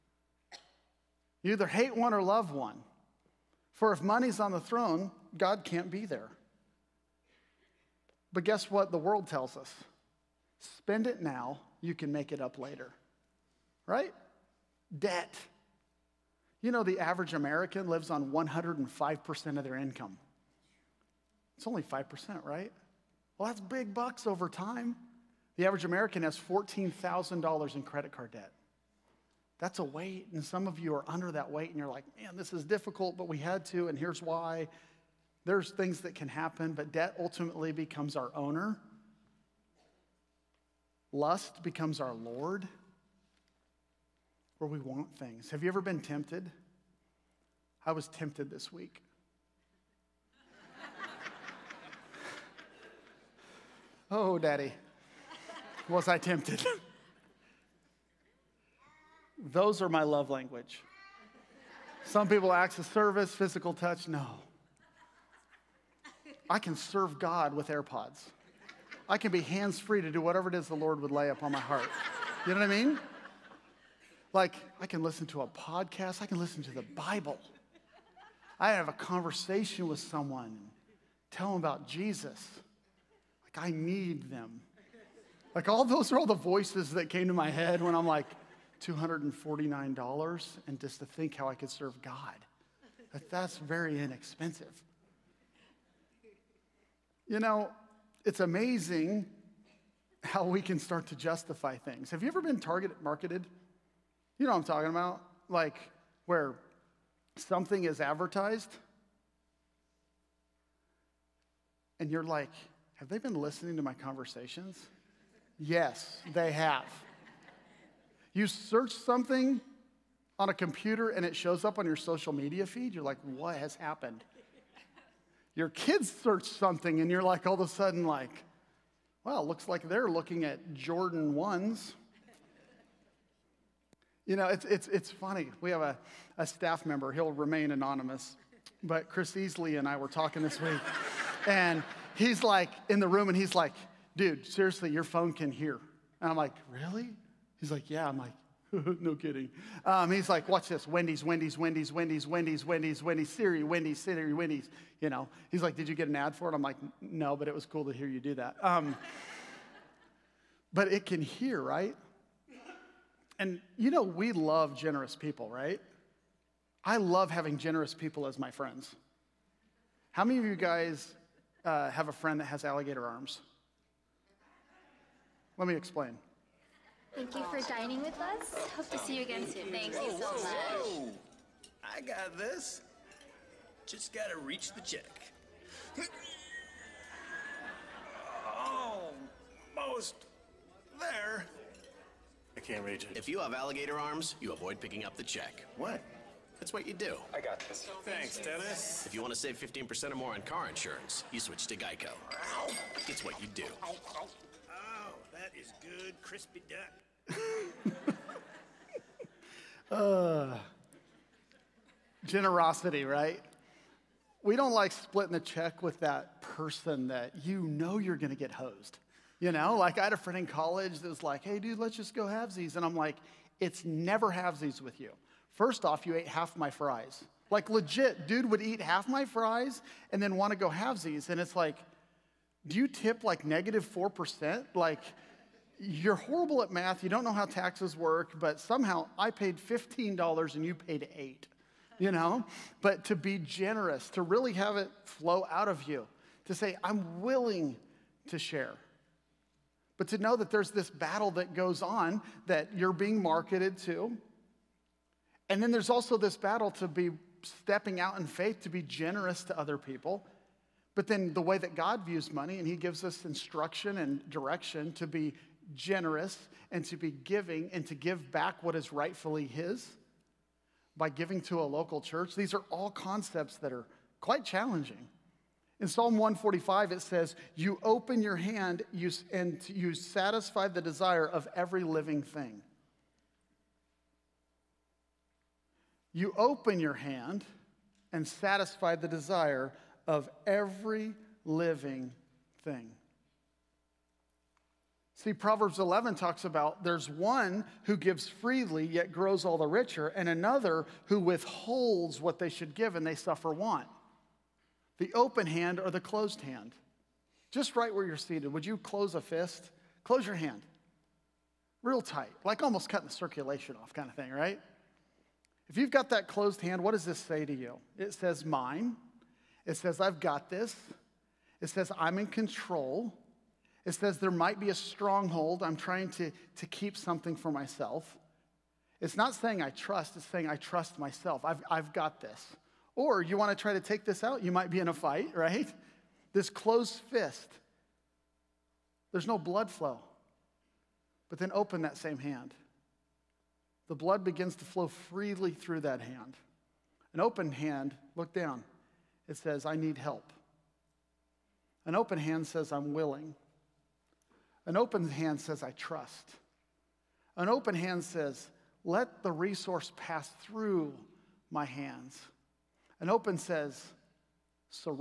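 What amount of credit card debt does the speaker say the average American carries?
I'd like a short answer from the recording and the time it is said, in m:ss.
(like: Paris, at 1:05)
$14,000, at 0:26.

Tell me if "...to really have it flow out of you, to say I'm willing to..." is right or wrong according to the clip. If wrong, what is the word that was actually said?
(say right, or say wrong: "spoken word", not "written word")
right.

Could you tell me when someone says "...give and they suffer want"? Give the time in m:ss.
5:02.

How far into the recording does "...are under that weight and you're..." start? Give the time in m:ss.
0:30.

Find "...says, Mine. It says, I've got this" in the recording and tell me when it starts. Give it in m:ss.
5:18.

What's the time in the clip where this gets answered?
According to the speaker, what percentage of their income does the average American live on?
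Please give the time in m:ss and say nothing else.
0:18.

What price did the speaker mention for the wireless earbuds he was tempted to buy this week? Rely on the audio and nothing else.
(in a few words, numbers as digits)
$249.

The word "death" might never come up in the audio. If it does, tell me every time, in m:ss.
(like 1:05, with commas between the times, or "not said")
not said.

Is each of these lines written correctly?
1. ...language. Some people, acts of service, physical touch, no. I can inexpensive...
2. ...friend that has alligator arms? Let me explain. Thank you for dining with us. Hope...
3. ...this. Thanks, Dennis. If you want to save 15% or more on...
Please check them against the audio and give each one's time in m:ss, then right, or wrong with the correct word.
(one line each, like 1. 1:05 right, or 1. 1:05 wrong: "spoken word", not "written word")
1. 1:00 wrong: "serve", not "inexpensive"
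2. 2:52 right
3. 3:17 right.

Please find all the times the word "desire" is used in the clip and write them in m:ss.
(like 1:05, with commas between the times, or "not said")
4:40, 4:49.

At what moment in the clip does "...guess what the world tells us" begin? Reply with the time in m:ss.
0:08.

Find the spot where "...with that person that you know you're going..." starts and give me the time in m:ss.
3:35.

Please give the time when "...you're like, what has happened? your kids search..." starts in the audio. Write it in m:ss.
2:02.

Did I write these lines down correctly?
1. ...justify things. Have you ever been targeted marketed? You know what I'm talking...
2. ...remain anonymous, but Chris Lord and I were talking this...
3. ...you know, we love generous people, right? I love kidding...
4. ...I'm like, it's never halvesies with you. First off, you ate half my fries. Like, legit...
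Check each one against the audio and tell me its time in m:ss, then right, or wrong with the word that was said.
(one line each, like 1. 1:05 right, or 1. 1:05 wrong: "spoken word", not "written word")
1. 1:41 right
2. 2:17 wrong: "Easley", not "Lord"
3. 2:43 wrong: "having", not "kidding"
4. 3:42 right.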